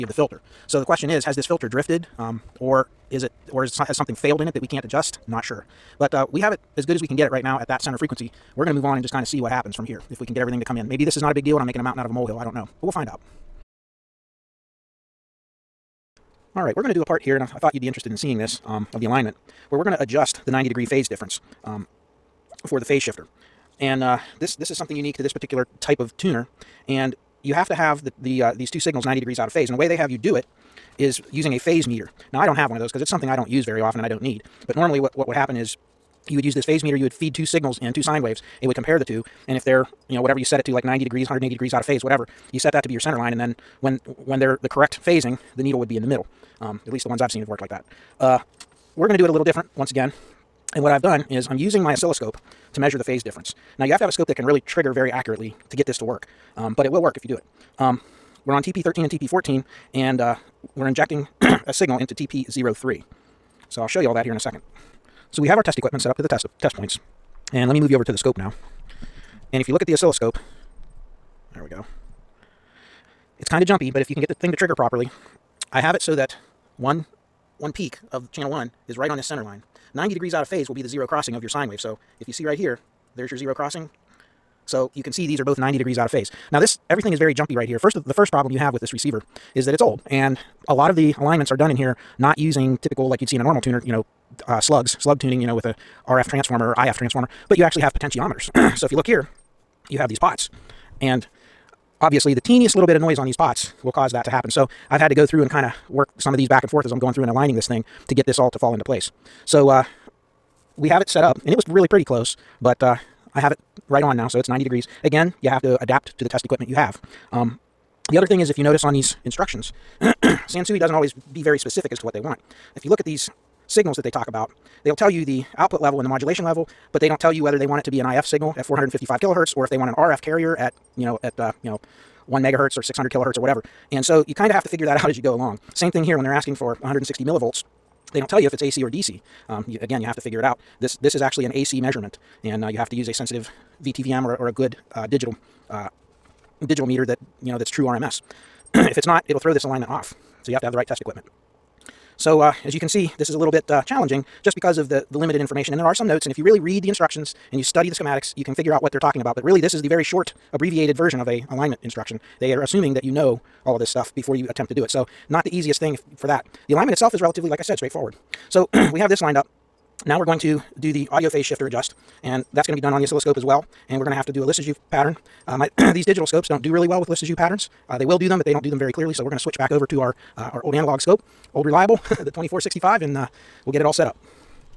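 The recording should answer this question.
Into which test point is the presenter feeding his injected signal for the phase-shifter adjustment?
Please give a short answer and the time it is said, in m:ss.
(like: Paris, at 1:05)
TP03, at 1:02.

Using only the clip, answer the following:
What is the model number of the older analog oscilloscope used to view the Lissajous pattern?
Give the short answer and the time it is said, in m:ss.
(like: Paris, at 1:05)
2465, at 3:02.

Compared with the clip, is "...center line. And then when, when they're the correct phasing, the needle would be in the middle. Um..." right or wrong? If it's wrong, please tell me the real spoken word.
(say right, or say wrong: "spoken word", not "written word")
right.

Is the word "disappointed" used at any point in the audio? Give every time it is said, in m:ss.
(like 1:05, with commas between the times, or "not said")
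not said.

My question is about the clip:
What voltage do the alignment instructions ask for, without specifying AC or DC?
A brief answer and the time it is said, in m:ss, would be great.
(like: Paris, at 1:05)
160 millivolts, at 2:16.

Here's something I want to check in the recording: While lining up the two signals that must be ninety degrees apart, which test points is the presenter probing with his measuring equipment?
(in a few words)
TP13 and TP14.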